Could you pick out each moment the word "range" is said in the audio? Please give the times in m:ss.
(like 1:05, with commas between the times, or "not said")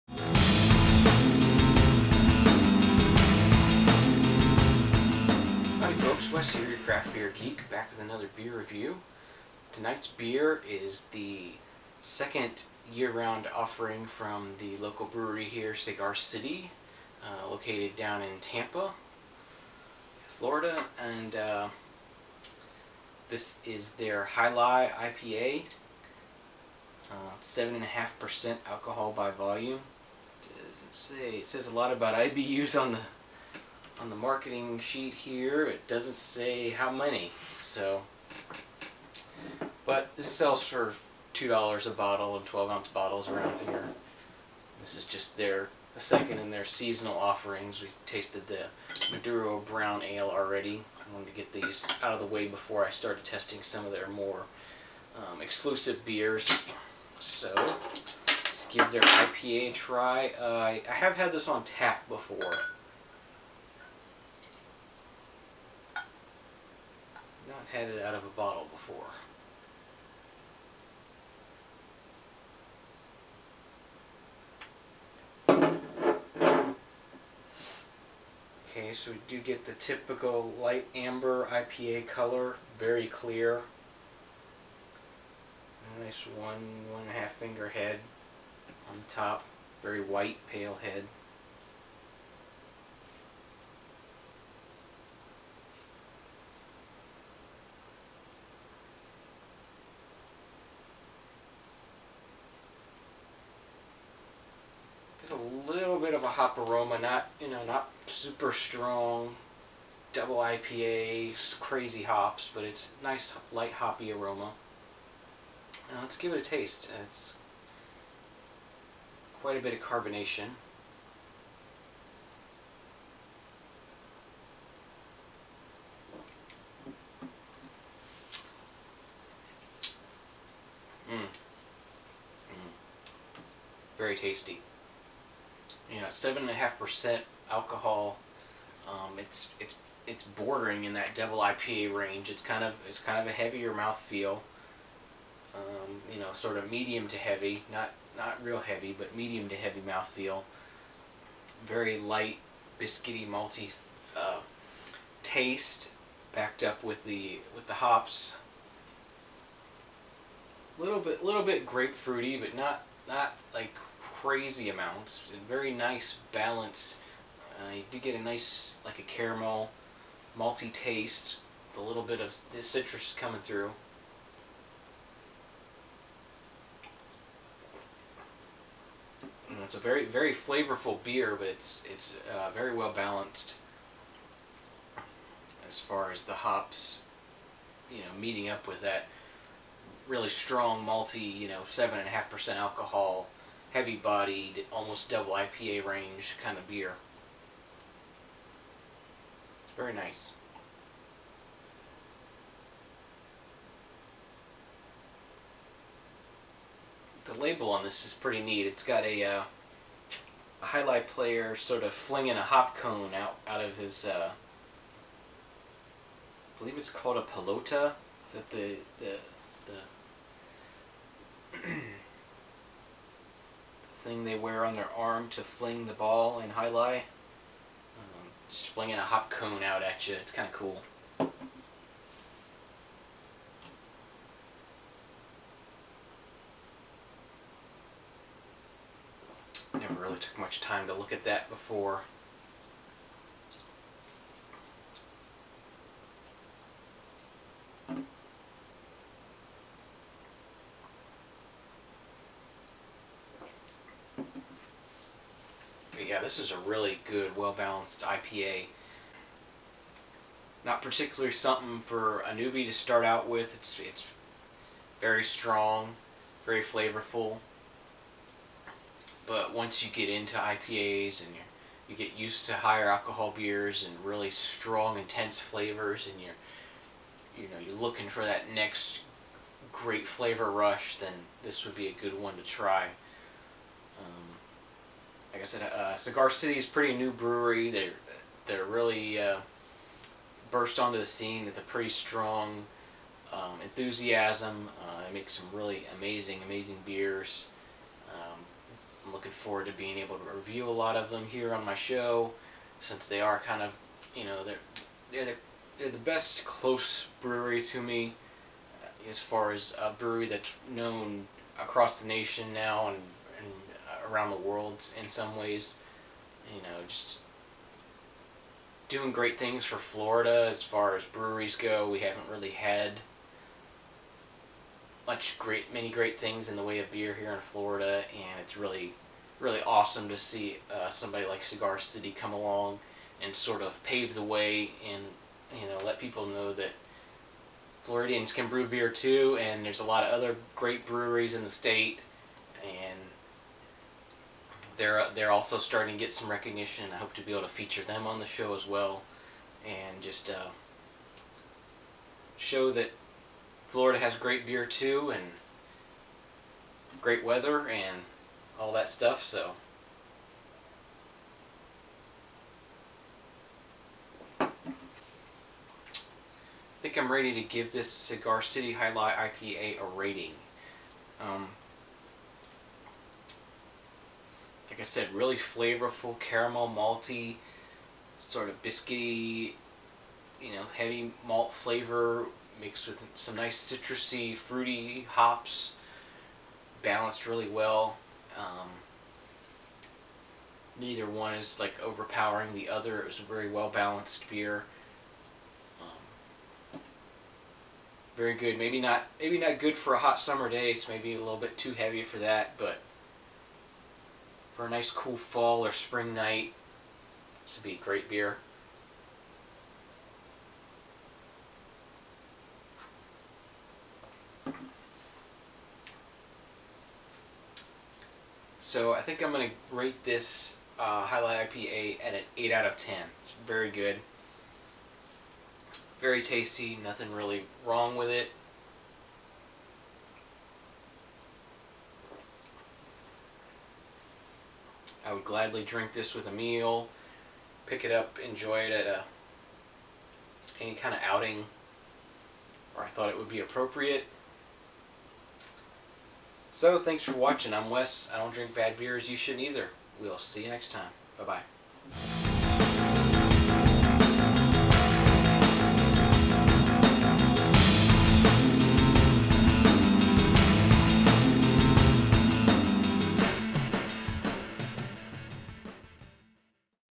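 2:21, 3:15.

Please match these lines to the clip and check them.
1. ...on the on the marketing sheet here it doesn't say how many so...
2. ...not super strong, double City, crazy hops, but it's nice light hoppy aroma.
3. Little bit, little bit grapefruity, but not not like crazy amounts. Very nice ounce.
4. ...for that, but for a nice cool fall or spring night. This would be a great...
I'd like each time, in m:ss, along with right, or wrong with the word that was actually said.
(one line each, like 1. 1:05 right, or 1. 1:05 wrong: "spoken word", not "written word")
1. 0:32 right
2. 1:47 wrong: "IPA", not "City"
3. 2:40 wrong: "balance", not "ounce"
4. 6:42 right.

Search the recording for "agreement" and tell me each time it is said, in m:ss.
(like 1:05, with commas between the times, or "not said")
not said.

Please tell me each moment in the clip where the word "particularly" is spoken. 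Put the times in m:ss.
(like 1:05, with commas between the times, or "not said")
4:20.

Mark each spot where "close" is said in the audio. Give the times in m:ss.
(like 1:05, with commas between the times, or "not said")
5:06.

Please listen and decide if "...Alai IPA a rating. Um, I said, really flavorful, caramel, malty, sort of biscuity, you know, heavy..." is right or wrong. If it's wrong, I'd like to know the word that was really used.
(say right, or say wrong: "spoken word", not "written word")
right.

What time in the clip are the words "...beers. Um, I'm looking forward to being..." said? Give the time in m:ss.
4:56.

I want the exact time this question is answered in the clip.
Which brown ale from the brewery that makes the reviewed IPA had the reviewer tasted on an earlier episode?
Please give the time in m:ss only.
0:49.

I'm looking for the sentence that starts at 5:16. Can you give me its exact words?
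You know, just doing great things for Florida as far as breweries go.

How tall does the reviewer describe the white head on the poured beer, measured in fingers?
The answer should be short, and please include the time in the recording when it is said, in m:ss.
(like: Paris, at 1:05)
1.5 fingers, at 1:26.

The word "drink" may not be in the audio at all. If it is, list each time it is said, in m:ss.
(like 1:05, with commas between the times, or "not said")
7:15, 7:28.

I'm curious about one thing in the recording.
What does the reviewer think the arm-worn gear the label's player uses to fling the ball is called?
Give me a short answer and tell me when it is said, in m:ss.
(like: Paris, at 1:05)
pelota, at 3:37.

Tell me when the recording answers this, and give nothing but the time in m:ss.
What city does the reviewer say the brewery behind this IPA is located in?
0:18.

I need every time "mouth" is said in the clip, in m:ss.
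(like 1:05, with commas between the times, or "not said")
2:23, 2:29.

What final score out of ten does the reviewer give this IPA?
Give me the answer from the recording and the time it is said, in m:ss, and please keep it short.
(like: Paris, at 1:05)
8, at 7:02.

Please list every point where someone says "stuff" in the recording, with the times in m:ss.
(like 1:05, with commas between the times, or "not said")
5:58.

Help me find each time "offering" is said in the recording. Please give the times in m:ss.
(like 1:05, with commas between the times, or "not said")
0:13, 0:47.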